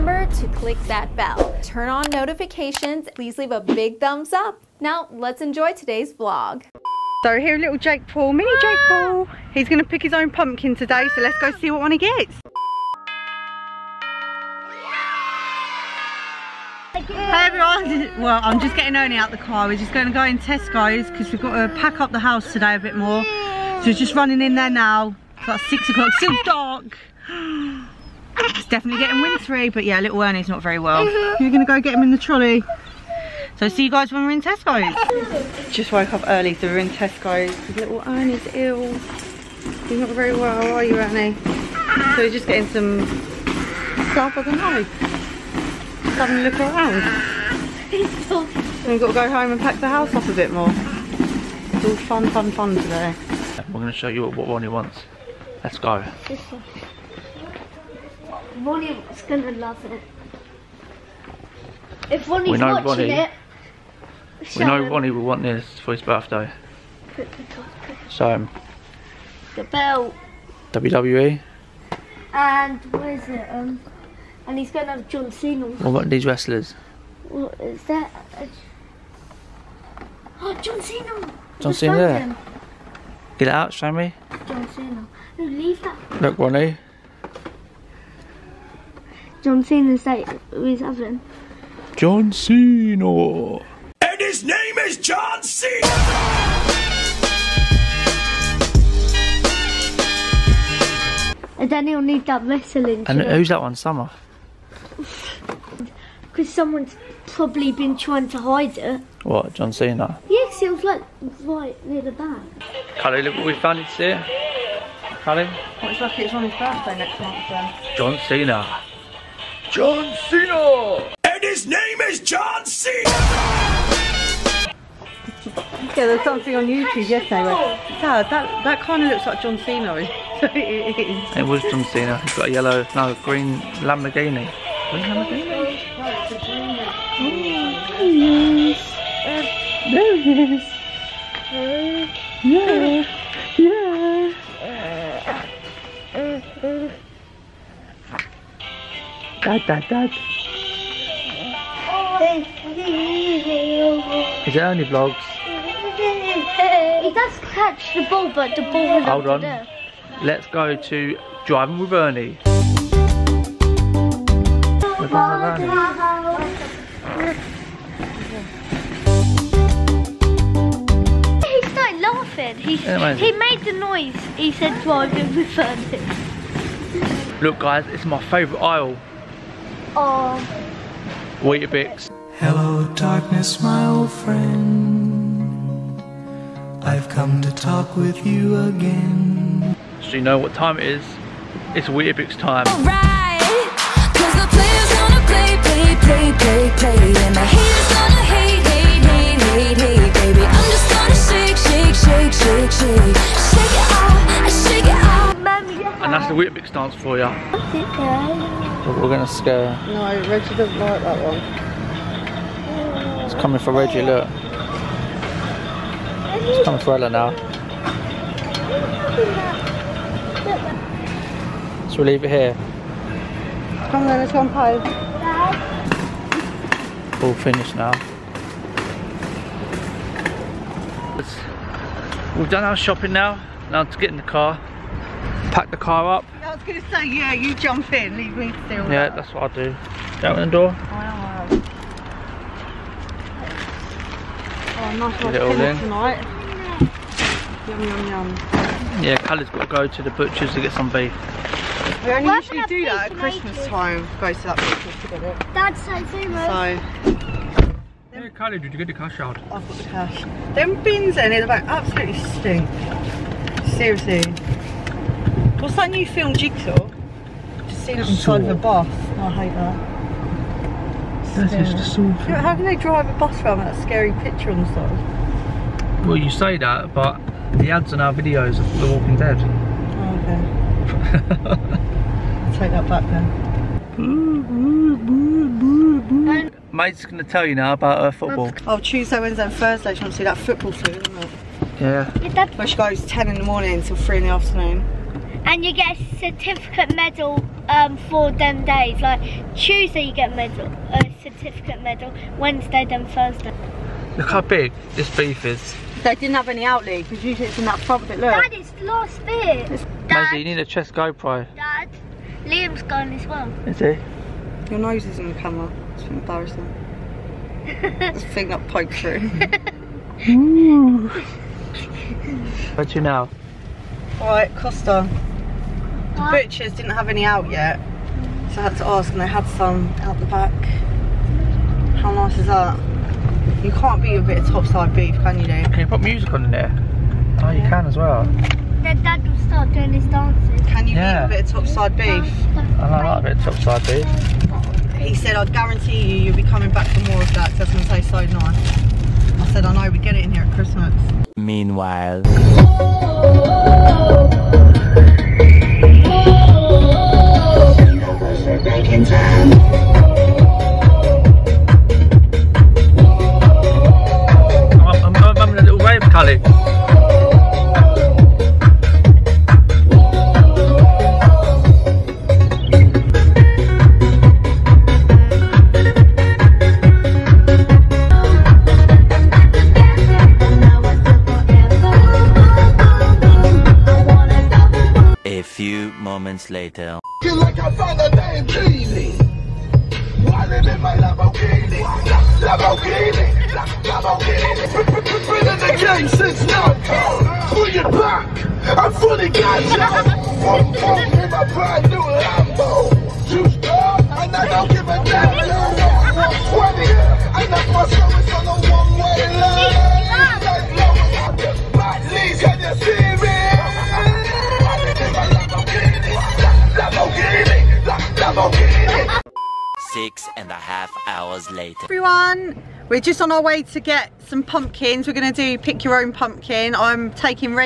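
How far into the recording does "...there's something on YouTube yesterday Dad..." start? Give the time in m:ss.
2:05.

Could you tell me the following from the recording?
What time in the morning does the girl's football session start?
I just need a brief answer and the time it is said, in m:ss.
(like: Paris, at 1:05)
10, at 4:53.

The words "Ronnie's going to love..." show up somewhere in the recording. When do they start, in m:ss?
0:58.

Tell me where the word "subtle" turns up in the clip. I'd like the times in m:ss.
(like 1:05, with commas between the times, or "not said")
not said.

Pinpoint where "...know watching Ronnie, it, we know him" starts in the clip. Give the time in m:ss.
1:02.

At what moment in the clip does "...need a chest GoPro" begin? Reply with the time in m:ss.
5:10.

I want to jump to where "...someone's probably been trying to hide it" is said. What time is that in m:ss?
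1:46.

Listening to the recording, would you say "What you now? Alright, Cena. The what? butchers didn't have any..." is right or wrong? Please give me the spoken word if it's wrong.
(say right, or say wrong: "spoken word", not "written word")
wrong: "Costa", not "Cena".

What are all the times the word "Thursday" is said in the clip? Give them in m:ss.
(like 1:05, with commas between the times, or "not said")
4:49, 5:03.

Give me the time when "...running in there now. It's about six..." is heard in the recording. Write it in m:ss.
0:24.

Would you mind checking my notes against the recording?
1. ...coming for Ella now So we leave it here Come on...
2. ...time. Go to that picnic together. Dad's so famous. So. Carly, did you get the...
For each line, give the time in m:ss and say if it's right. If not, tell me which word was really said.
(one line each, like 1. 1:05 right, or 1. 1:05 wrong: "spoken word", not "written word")
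1. 3:36 right
2. 4:13 right.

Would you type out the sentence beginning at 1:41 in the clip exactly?
And then he'll need that wrestling.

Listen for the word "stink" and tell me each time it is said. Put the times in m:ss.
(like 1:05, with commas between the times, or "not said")
4:22.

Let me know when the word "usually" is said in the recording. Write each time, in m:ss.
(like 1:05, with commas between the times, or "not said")
4:12, 5:07.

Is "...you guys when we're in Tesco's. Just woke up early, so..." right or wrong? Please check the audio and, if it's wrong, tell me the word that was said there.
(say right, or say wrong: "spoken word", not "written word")
right.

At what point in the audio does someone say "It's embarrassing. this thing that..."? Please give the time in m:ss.
5:15.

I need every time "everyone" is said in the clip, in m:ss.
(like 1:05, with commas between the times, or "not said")
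0:17, 7:01.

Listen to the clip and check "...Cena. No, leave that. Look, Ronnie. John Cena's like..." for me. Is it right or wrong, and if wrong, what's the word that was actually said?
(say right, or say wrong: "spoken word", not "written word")
right.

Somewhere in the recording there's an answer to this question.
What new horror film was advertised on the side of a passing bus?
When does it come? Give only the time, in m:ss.
4:26.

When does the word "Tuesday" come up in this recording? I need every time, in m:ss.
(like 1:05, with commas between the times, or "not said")
4:48, 4:59.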